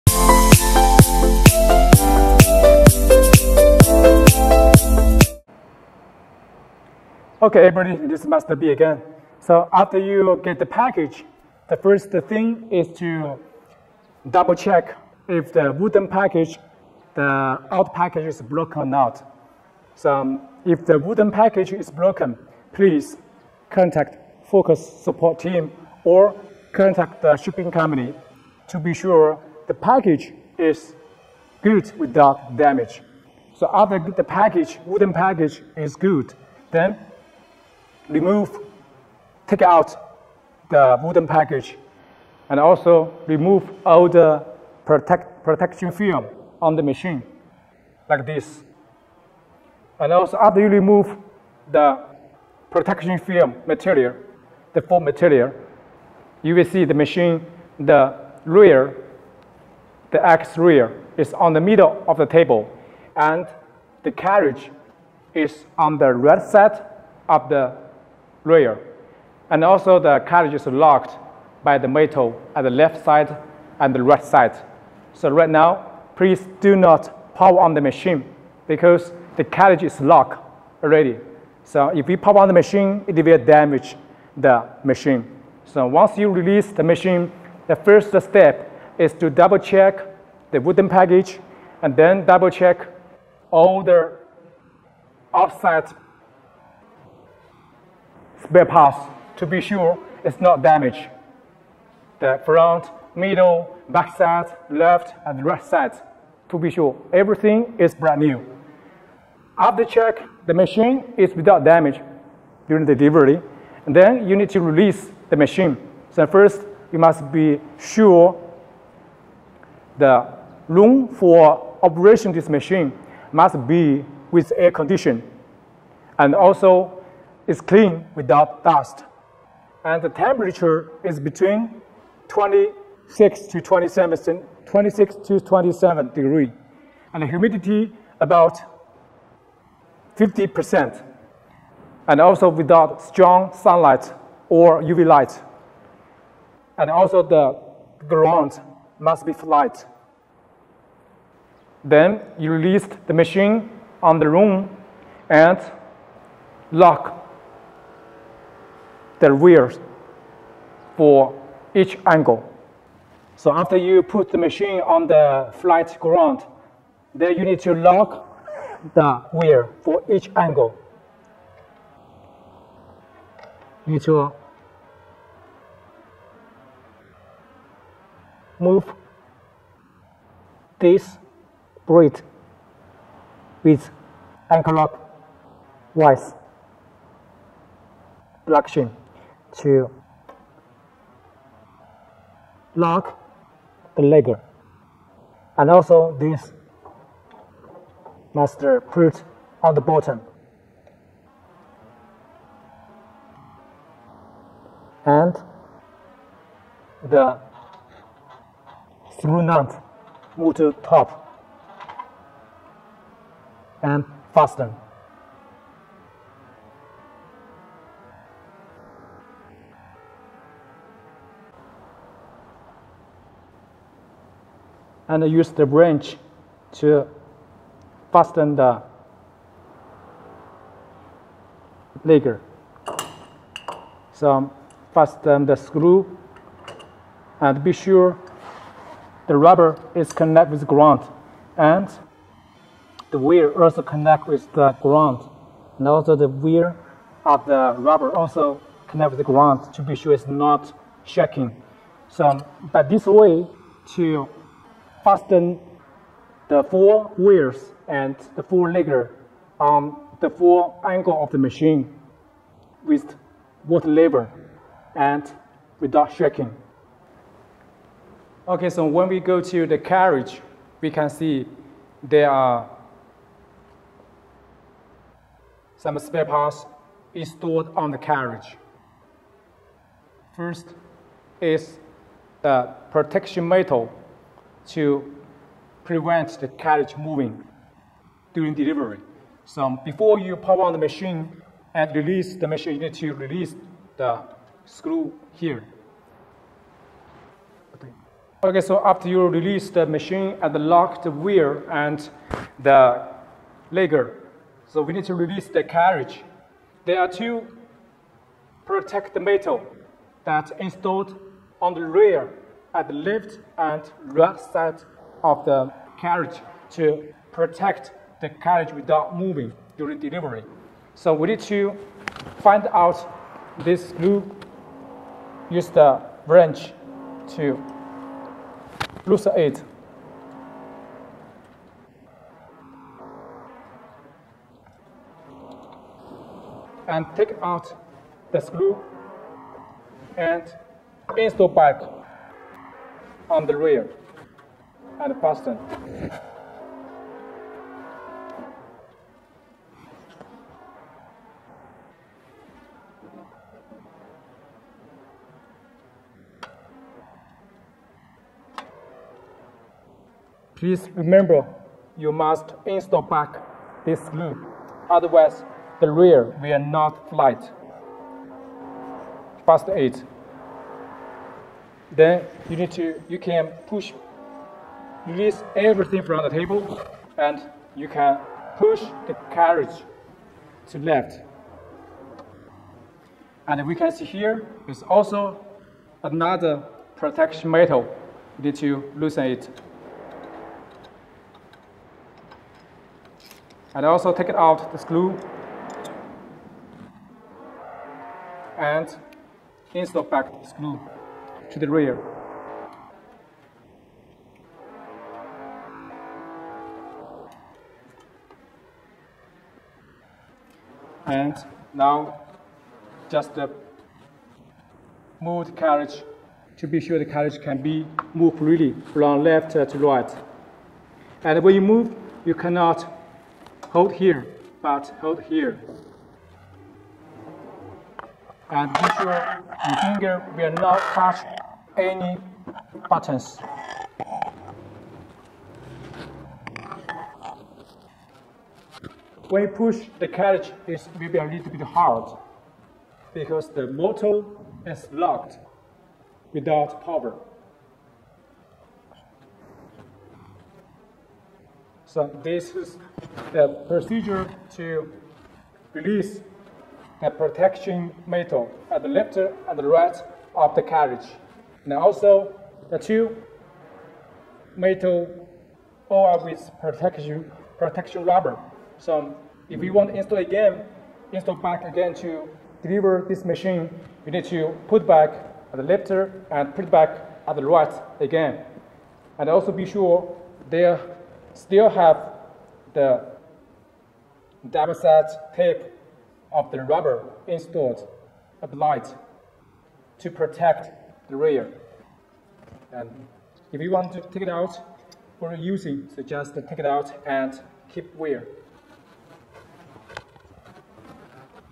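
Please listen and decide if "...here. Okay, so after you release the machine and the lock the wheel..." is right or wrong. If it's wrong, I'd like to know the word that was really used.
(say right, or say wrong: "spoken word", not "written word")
right.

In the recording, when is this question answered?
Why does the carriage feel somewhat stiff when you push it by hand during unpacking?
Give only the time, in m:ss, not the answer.
7:23.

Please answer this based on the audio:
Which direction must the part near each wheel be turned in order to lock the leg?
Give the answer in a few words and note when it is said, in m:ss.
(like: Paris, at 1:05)
anti-clockwise, at 3:04.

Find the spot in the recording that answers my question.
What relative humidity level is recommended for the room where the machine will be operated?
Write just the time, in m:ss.
2:20.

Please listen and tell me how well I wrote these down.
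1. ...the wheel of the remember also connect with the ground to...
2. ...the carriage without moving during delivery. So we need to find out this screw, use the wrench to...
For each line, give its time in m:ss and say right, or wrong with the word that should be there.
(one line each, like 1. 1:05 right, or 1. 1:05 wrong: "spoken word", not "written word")
1. 4:06 wrong: "rubber", not "remember"
2. 5:18 right.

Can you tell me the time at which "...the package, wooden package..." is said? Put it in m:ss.
0:34.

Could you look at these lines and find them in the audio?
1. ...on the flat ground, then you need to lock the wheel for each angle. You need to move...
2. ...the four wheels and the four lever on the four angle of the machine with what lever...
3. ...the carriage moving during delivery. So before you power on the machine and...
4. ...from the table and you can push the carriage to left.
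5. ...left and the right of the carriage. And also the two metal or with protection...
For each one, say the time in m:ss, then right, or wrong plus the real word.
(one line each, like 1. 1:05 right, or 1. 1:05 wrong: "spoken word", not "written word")
1. 2:44 right
2. 4:16 right
3. 4:46 right
4. 6:16 right
5. 7:38 right.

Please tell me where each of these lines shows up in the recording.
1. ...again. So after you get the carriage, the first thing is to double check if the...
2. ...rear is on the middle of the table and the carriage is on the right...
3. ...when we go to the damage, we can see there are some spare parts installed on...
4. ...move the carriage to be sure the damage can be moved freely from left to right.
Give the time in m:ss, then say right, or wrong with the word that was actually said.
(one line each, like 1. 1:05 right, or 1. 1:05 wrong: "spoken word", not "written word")
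1. 0:08 wrong: "package", not "carriage"
2. 1:00 right
3. 4:28 wrong: "carriage", not "damage"
4. 6:55 wrong: "carriage", not "damage".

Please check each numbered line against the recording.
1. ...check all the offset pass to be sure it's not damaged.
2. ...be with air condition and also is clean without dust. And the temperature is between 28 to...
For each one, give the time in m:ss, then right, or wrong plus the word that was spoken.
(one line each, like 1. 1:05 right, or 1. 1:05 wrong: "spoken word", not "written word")
1. 1:32 right
2. 2:03 wrong: "26", not "28".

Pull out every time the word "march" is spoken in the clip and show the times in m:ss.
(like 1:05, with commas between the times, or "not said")
not said.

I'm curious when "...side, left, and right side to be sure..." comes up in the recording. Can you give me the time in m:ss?
1:44.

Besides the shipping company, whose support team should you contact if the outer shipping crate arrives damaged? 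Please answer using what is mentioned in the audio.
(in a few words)
Focus.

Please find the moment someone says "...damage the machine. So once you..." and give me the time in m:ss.
1:23.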